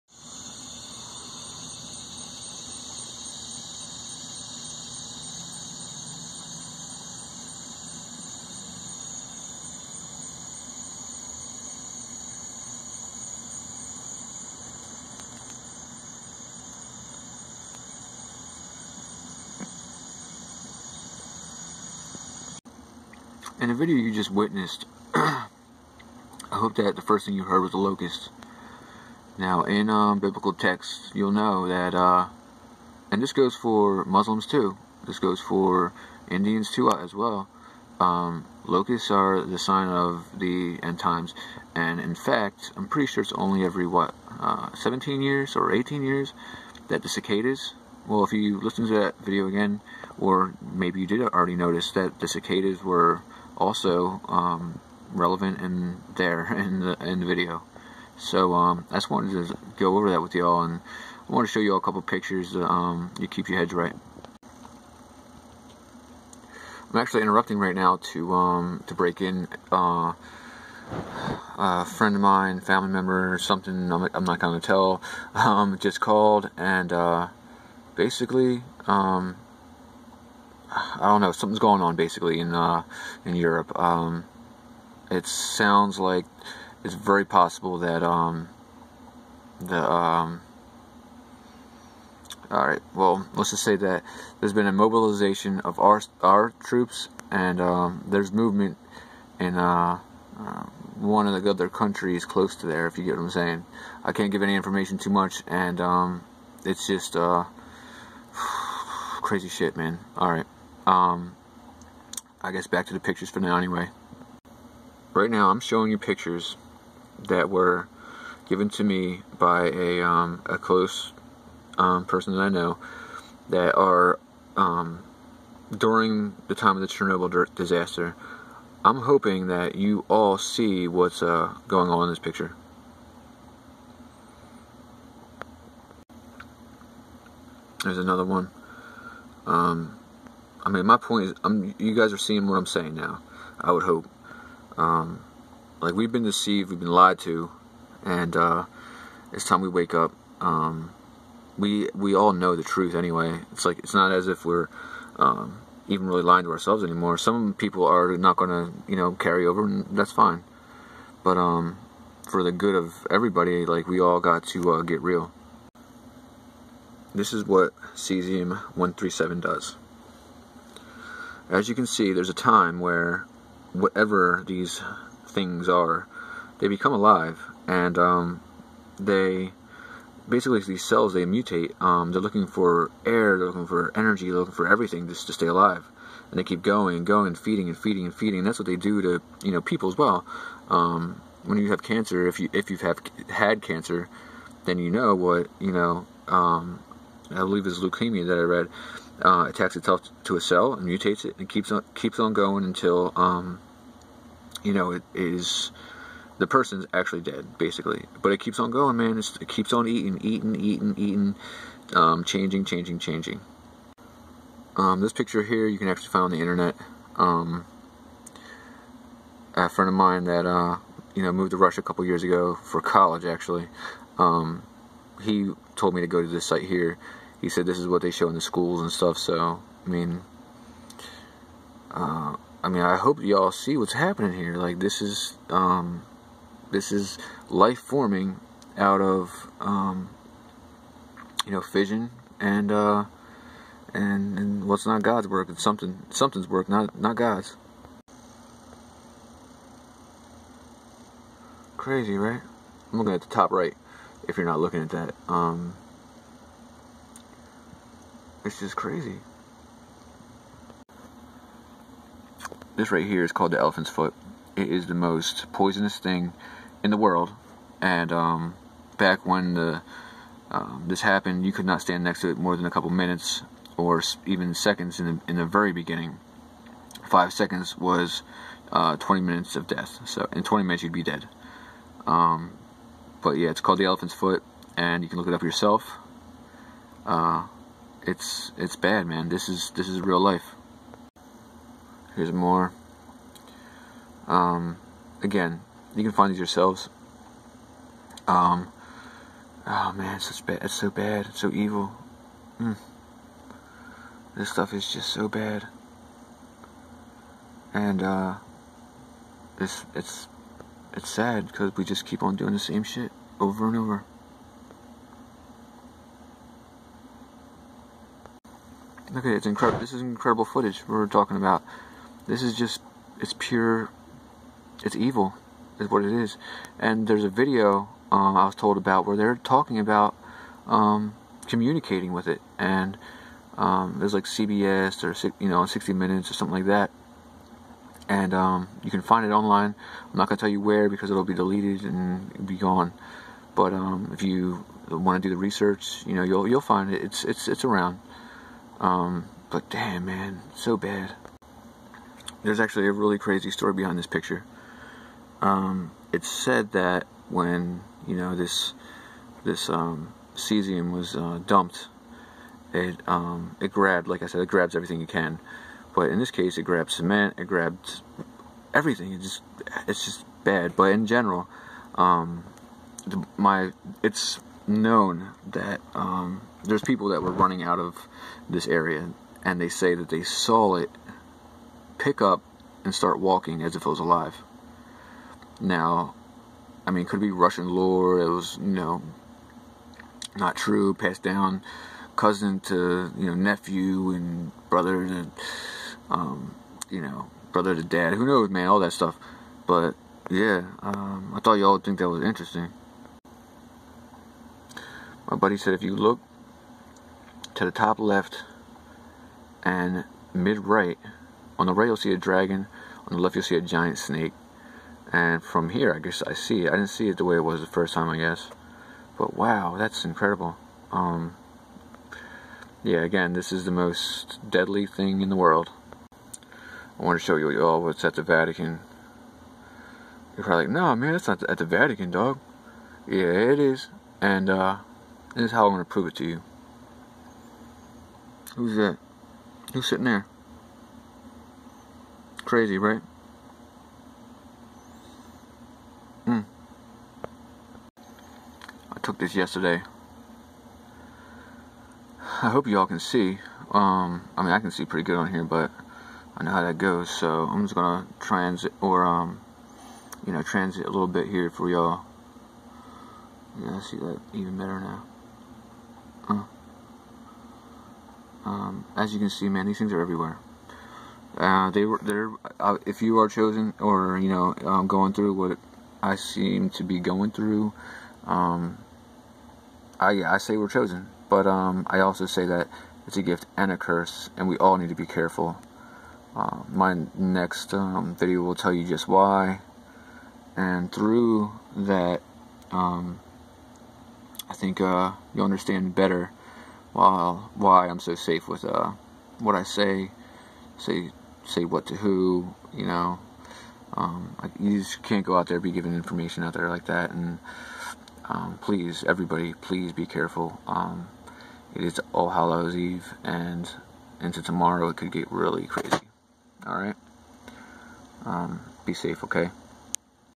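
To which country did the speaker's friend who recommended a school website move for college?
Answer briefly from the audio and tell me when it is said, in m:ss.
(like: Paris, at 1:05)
Russia, at 3:41.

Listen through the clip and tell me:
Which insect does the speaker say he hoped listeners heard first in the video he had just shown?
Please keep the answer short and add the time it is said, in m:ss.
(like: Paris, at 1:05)
a locust, at 0:27.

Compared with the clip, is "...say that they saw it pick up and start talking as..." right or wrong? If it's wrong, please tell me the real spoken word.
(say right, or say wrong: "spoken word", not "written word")
wrong: "walking", not "talking".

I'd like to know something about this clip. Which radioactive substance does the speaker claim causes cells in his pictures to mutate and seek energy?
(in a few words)
cesium 137.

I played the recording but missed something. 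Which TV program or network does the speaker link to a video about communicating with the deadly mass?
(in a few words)
60 Minutes.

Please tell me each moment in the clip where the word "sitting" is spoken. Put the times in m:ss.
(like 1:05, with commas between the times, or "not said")
7:19.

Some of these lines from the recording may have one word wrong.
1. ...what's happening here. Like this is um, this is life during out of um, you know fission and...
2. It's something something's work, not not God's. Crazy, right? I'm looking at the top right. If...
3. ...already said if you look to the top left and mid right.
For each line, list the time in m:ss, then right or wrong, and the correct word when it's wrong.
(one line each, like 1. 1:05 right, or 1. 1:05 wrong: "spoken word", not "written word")
1. 3:53 wrong: "forming", not "during"
2. 4:05 right
3. 6:45 wrong: "buddy", not "already".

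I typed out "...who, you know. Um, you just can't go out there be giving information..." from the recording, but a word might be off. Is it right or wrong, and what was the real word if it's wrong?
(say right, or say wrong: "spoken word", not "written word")
right.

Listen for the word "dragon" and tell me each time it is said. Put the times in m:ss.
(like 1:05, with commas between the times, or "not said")
6:52.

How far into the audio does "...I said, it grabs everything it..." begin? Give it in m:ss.
6:04.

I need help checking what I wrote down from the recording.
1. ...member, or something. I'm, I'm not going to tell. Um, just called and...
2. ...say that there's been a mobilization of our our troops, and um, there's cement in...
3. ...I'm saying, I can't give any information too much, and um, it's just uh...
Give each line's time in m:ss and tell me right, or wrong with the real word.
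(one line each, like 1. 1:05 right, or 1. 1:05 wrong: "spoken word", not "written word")
1. 1:12 right
2. 1:33 wrong: "movement", not "cement"
3. 1:43 right.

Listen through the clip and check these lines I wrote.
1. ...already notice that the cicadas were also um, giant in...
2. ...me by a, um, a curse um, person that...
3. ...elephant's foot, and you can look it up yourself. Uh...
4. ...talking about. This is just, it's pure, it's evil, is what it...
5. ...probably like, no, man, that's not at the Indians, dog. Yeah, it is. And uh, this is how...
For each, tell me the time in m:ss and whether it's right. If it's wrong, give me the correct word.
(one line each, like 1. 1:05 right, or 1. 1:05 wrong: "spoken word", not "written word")
1. 0:51 wrong: "relevant", not "giant"
2. 1:58 wrong: "close", not "curse"
3. 4:43 right
4. 5:21 right
5. 7:10 wrong: "Vatican", not "Indians".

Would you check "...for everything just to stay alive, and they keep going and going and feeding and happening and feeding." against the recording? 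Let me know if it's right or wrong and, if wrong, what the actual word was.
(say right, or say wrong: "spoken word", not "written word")
wrong: "feeding", not "happening".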